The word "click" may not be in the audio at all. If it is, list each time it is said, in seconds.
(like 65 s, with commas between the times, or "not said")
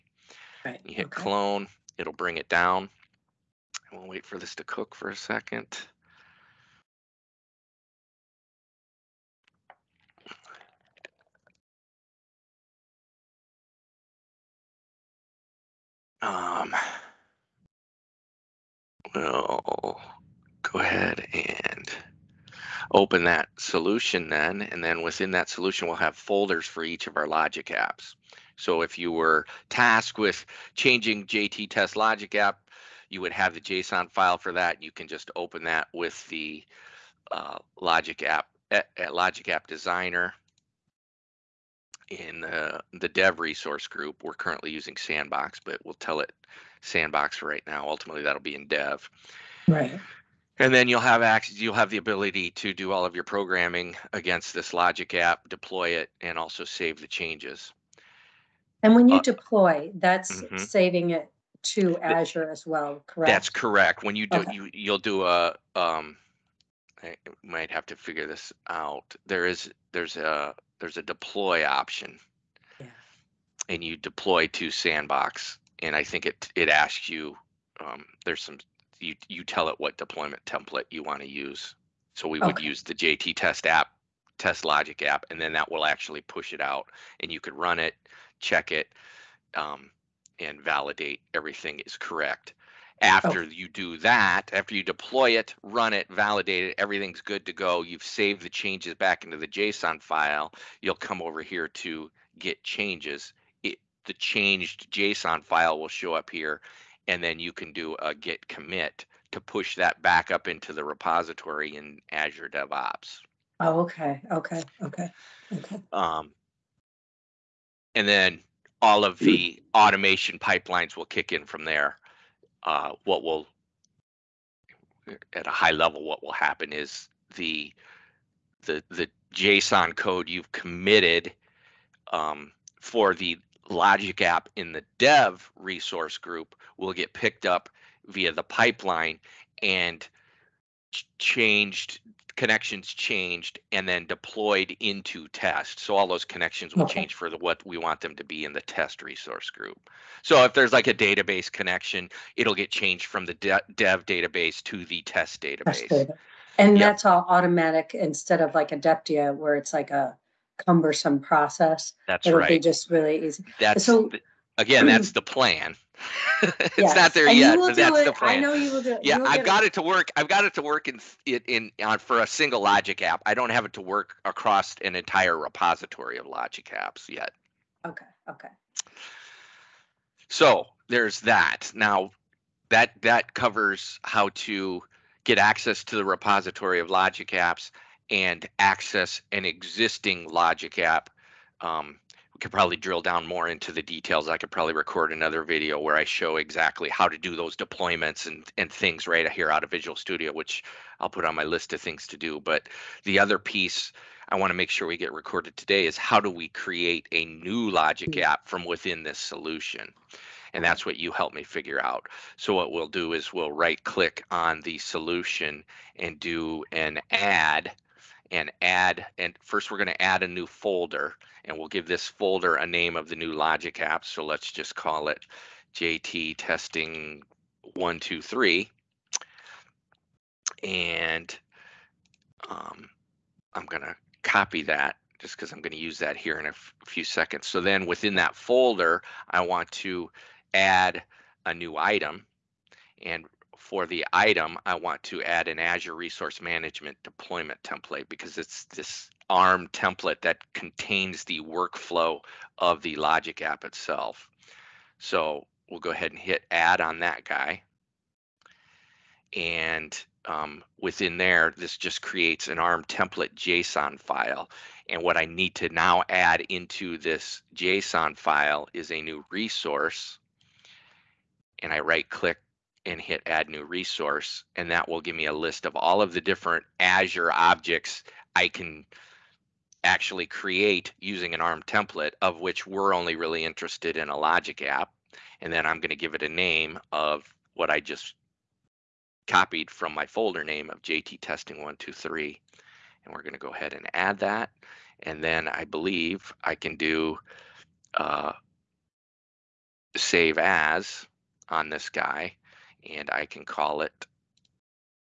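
213 s, 272 s.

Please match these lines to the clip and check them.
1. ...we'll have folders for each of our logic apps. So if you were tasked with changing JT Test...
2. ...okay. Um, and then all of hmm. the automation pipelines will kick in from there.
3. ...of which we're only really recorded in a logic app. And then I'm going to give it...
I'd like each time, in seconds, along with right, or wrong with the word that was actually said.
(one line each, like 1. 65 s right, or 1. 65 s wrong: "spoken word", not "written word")
1. 25 s right
2. 115 s right
3. 282 s wrong: "interested", not "recorded".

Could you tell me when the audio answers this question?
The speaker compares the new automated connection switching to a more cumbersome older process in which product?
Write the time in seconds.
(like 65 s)
158 s.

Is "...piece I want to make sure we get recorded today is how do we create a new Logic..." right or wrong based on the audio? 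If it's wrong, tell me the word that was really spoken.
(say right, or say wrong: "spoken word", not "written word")
right.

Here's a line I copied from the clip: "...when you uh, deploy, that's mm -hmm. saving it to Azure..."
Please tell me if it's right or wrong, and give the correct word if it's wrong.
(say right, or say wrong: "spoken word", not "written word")
right.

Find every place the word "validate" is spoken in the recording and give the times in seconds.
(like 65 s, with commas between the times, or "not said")
90 s, 96 s.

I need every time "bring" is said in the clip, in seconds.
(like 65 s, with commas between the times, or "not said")
2 s.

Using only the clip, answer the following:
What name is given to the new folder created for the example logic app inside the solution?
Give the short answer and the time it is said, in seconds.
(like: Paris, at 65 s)
JT testing 123, at 225 s.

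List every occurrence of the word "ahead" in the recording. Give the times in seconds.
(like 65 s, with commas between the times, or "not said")
20 s, 255 s, 293 s.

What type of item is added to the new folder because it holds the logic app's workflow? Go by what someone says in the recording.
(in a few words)
Azure Resource Management deployment template.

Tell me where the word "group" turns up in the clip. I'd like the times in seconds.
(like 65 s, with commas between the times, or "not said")
43 s, 136 s, 149 s.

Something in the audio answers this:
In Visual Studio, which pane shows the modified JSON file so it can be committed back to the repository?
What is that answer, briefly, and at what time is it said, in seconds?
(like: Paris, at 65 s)
Git Changes, at 102 s.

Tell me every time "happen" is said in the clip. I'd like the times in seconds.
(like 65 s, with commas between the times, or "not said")
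126 s.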